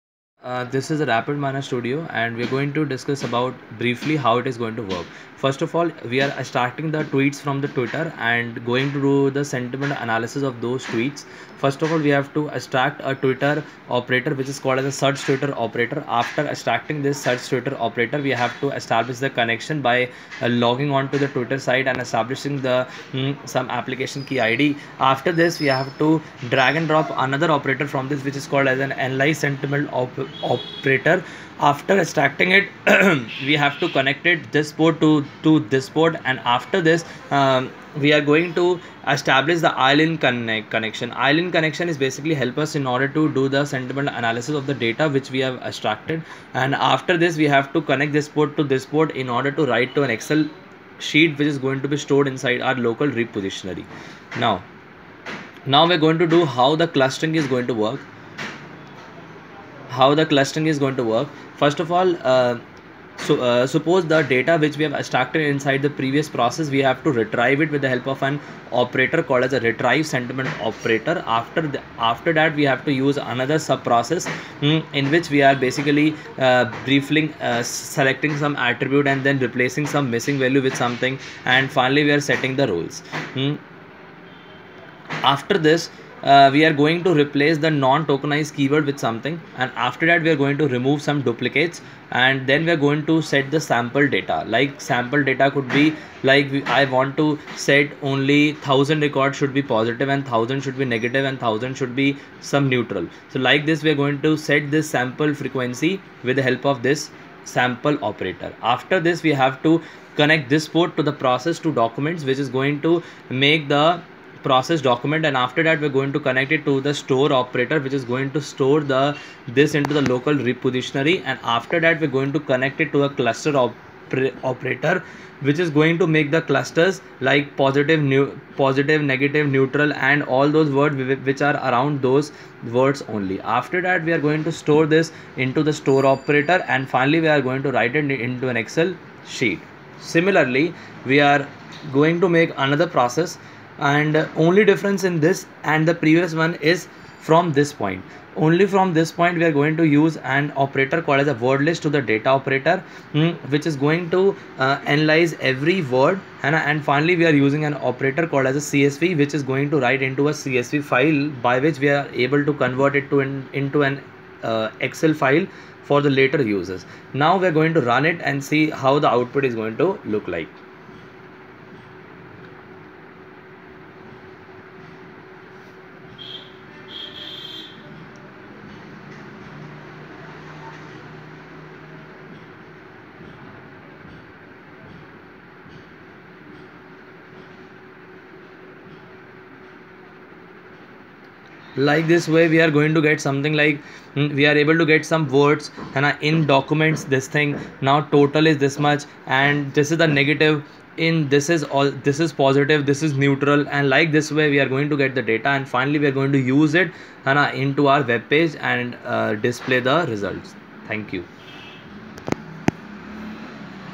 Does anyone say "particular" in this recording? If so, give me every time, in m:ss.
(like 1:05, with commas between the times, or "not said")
not said.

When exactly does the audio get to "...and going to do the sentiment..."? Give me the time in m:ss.
0:08.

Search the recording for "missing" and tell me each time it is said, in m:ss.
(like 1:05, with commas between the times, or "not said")
1:20.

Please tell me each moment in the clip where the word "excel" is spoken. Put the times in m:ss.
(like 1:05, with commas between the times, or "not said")
0:50, 2:18, 2:44.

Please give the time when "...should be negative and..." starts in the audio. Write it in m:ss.
1:40.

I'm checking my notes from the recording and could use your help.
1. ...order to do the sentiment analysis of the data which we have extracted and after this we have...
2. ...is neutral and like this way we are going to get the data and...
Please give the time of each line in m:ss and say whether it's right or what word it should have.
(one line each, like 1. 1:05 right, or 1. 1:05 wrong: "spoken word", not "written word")
1. 0:42 right
2. 3:23 right.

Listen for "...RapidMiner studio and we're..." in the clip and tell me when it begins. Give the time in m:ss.
0:01.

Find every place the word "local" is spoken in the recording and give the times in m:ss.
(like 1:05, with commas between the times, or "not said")
0:52, 2:00.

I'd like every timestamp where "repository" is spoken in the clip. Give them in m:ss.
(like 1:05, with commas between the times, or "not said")
0:53, 2:00.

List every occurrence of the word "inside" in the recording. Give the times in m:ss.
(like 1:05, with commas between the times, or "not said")
0:52, 1:05.